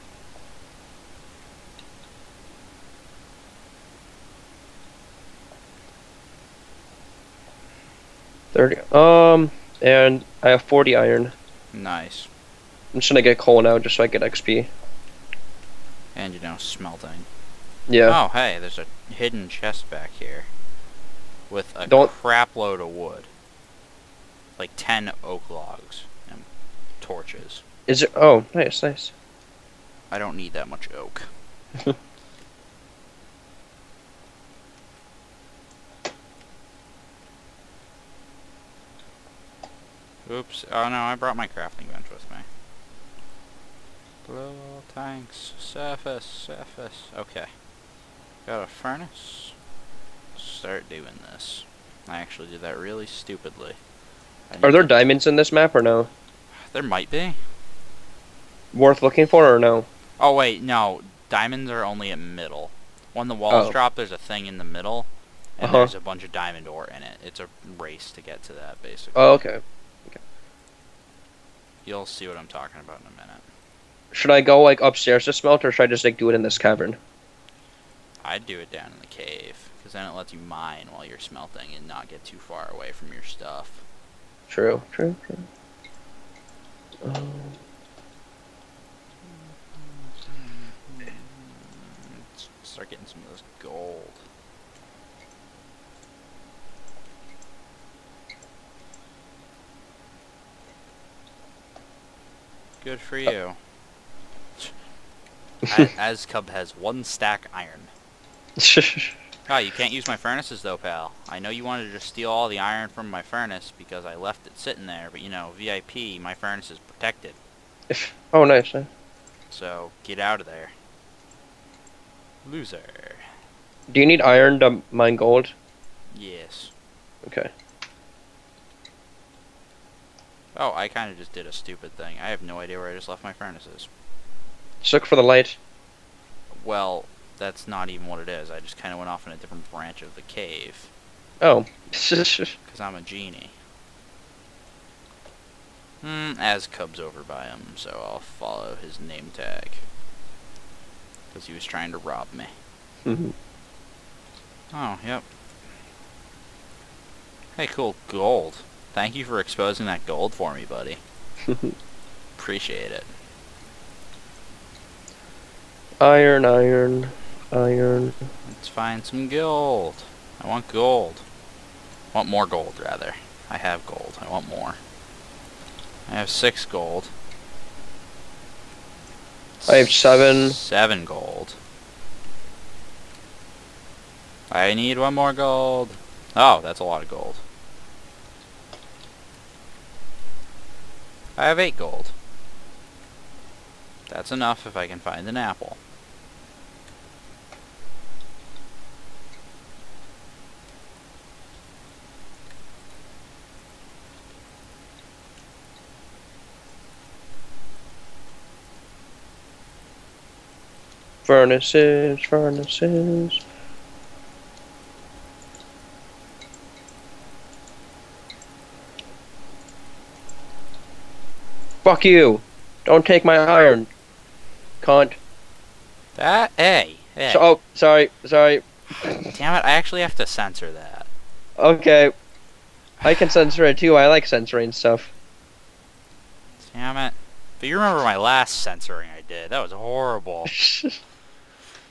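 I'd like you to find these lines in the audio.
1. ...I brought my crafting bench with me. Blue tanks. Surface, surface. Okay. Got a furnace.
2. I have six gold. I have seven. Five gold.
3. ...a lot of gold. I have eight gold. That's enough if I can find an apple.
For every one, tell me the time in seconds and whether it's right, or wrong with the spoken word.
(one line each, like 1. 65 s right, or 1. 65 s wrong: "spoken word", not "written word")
1. 40 s right
2. 176 s wrong: "Seven", not "Five"
3. 186 s right.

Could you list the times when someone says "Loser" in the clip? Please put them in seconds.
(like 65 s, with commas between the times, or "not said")
122 s.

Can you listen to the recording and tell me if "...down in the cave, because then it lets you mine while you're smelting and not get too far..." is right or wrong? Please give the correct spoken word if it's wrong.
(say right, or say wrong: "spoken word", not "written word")
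right.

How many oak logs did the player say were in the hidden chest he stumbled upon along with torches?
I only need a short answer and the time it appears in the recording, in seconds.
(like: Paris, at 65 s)
10, at 24 s.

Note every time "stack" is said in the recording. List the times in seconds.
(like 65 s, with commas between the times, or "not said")
107 s.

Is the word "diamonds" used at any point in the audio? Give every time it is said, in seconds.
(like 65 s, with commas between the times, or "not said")
54 s, 61 s, 66 s.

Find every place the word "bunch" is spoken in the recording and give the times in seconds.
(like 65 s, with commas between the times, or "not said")
65 s.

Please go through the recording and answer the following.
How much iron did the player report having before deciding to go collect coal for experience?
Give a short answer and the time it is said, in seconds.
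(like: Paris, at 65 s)
40, at 10 s.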